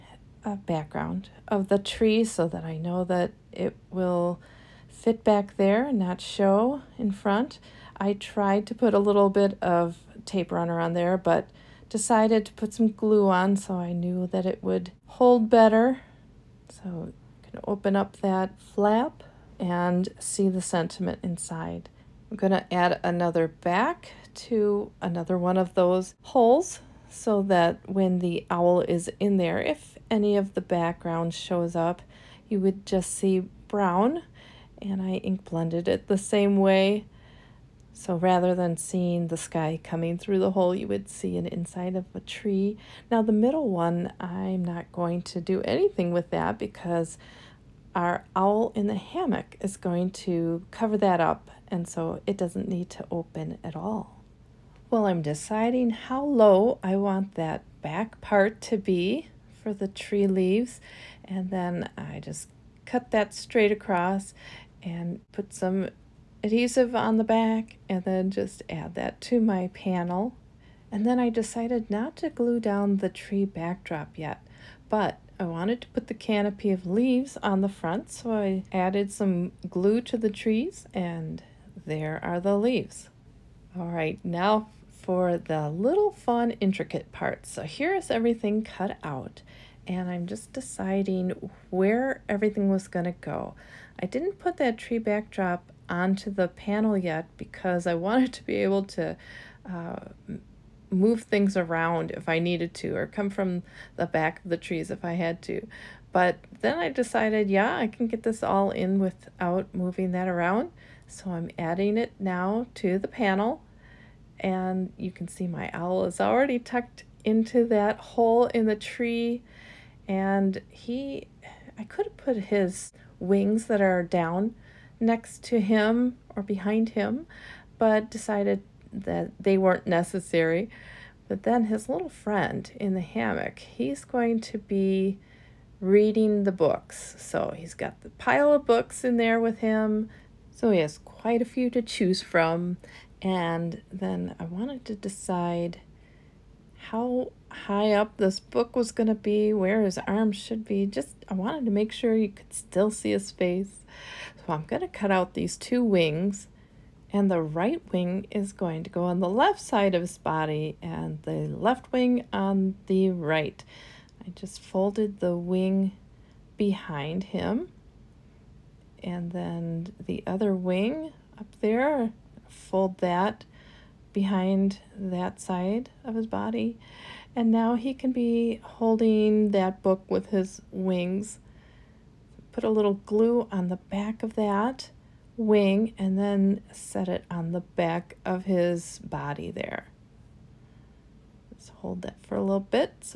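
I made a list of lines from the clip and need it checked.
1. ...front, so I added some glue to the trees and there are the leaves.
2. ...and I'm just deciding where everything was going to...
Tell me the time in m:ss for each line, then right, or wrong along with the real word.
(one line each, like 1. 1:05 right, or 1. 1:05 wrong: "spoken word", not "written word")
1. 1:17 right
2. 1:29 right.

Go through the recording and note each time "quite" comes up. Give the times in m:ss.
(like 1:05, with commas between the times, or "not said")
2:20.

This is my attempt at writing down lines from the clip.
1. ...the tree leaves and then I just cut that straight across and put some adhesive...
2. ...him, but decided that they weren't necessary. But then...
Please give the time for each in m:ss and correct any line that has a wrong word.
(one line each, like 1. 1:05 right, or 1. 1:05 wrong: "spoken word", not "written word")
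1. 0:59 right
2. 2:06 right.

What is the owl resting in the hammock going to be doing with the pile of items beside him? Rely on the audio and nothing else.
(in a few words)
reading the books.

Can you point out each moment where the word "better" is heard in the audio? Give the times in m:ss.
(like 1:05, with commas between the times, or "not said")
0:15.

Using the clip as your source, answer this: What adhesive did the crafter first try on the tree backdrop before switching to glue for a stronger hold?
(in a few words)
tape runner.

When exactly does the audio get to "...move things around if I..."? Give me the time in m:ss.
1:40.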